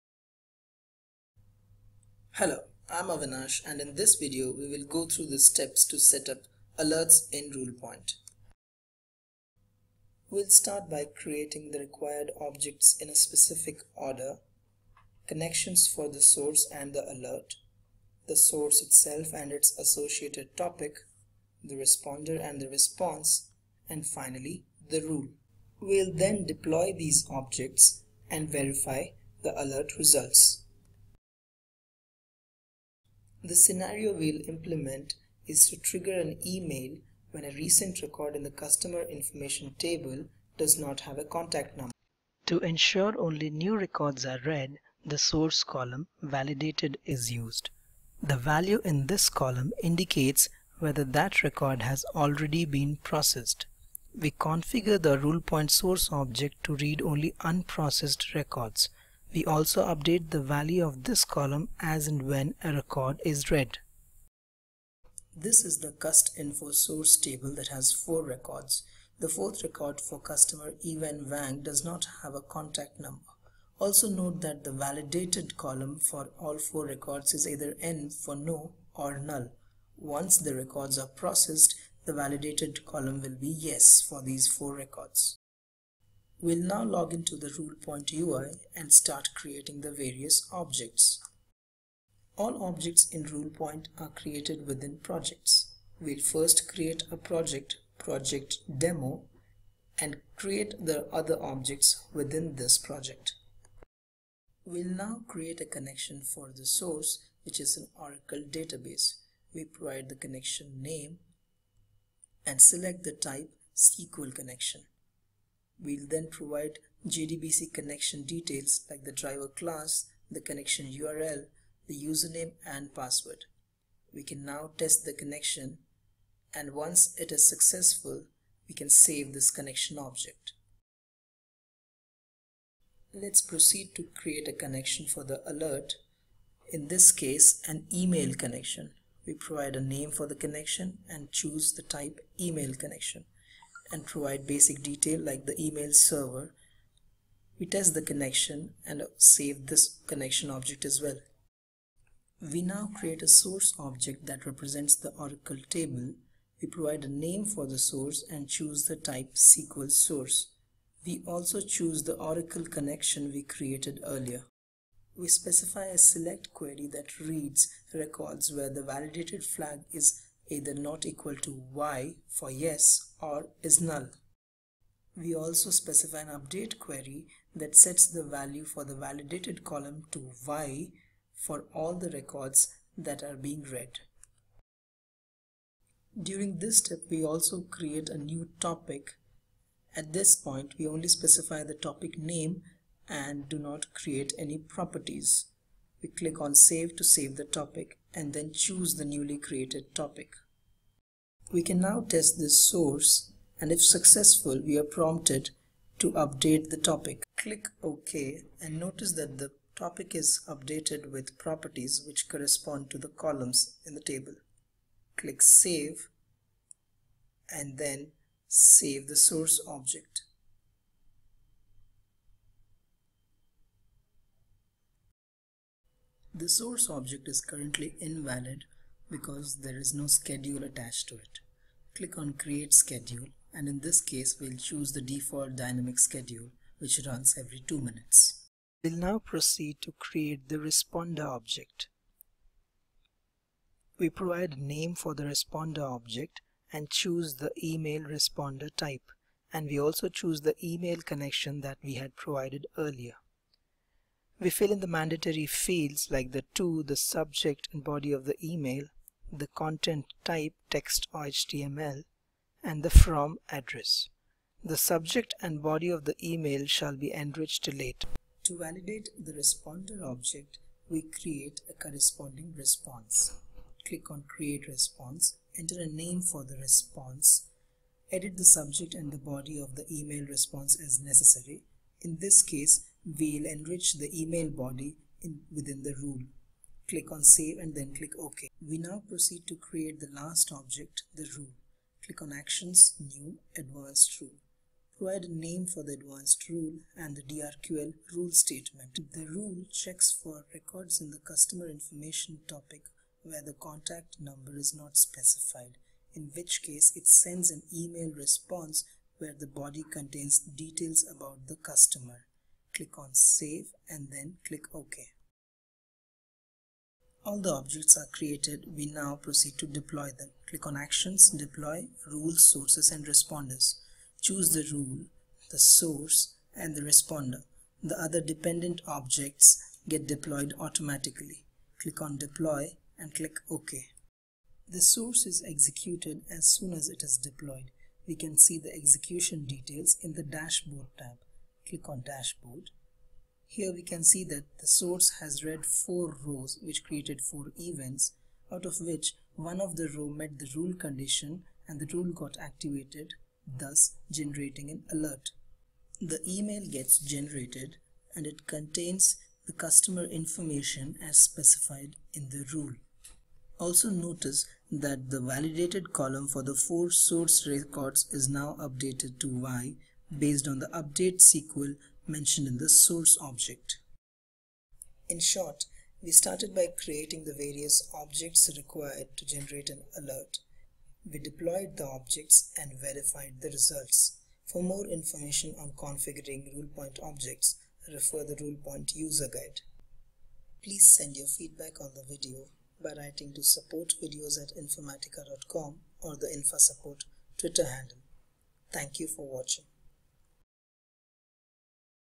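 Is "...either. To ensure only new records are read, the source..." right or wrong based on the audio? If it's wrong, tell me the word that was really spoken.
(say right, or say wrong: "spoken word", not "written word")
wrong: "number", not "either".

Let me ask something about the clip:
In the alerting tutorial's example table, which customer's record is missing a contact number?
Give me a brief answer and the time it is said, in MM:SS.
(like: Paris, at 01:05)
Evan Wang, at 01:10.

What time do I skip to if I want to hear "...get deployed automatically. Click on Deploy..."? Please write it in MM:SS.
05:29.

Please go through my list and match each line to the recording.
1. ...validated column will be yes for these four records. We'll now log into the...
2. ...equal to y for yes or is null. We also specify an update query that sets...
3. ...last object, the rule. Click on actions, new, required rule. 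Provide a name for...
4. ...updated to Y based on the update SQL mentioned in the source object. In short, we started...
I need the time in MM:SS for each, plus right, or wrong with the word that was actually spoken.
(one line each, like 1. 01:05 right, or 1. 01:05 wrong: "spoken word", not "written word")
1. 01:22 right
2. 02:51 right
3. 04:50 wrong: "advanced", not "required"
4. 06:08 right.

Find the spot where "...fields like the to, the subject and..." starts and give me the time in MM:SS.
04:15.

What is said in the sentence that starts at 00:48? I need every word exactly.
The value in this column indicates whether that record has already been processed.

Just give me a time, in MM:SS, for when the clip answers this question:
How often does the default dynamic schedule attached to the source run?
03:57.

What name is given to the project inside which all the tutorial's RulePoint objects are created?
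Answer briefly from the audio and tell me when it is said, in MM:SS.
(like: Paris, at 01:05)
project demo, at 01:37.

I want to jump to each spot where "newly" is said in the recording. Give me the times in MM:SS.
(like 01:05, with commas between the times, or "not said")
03:19.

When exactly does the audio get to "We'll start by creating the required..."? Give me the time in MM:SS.
00:10.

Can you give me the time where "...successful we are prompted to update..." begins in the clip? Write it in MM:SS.
03:23.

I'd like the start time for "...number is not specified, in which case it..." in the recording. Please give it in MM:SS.
05:04.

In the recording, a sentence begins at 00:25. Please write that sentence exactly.
We'll then deploy these objects and verify the alert results.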